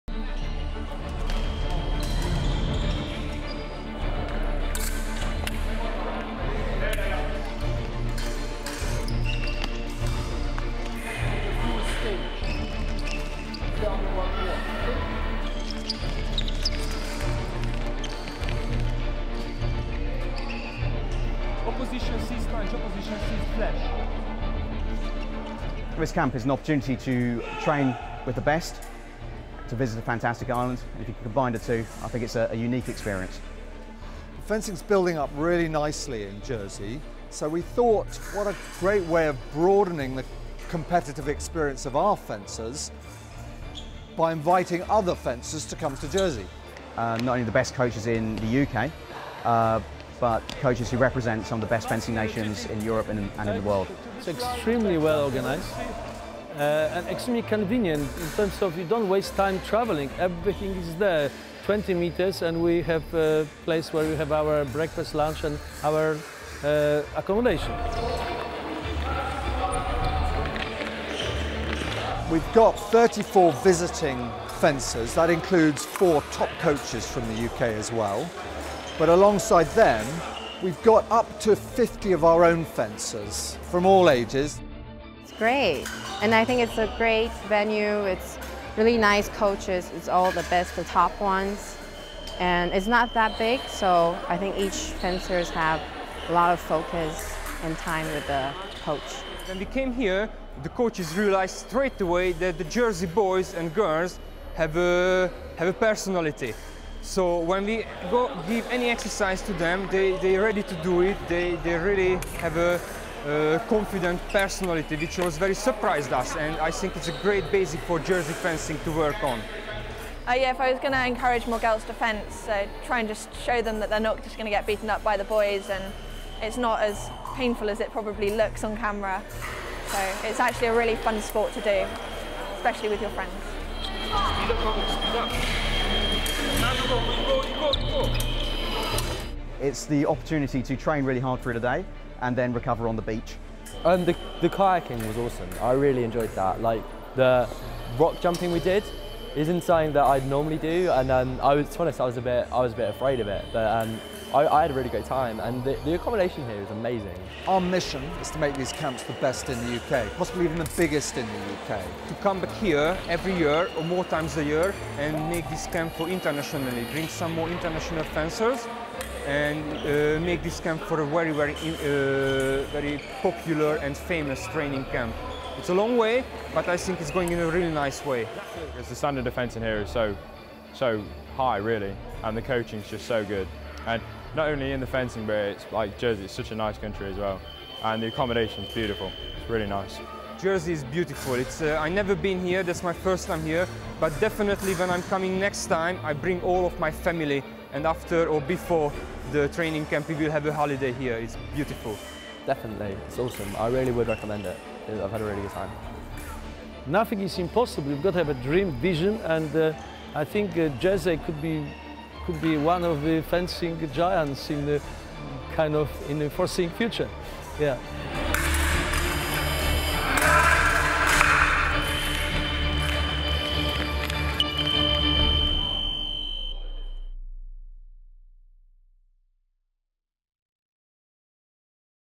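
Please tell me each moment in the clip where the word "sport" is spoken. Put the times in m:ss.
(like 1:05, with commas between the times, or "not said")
2:11.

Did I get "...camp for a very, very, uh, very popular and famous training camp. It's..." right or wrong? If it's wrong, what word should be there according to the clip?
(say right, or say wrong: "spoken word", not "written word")
right.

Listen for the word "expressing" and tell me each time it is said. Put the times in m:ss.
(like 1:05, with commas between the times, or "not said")
not said.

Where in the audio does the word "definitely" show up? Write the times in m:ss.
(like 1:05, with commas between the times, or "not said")
3:14, 3:22.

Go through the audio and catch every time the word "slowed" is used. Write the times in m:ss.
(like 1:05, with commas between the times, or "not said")
not said.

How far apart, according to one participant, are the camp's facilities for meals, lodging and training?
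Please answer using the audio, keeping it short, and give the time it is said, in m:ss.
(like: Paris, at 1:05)
20 meters, at 1:01.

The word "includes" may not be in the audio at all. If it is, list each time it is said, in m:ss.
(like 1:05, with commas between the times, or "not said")
1:15.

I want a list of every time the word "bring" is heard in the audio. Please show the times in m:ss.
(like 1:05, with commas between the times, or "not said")
2:46, 3:16.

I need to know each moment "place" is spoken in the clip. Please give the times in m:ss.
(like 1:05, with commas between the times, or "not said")
1:03.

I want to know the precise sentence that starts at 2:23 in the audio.
And um, the, the kayaking was awesome.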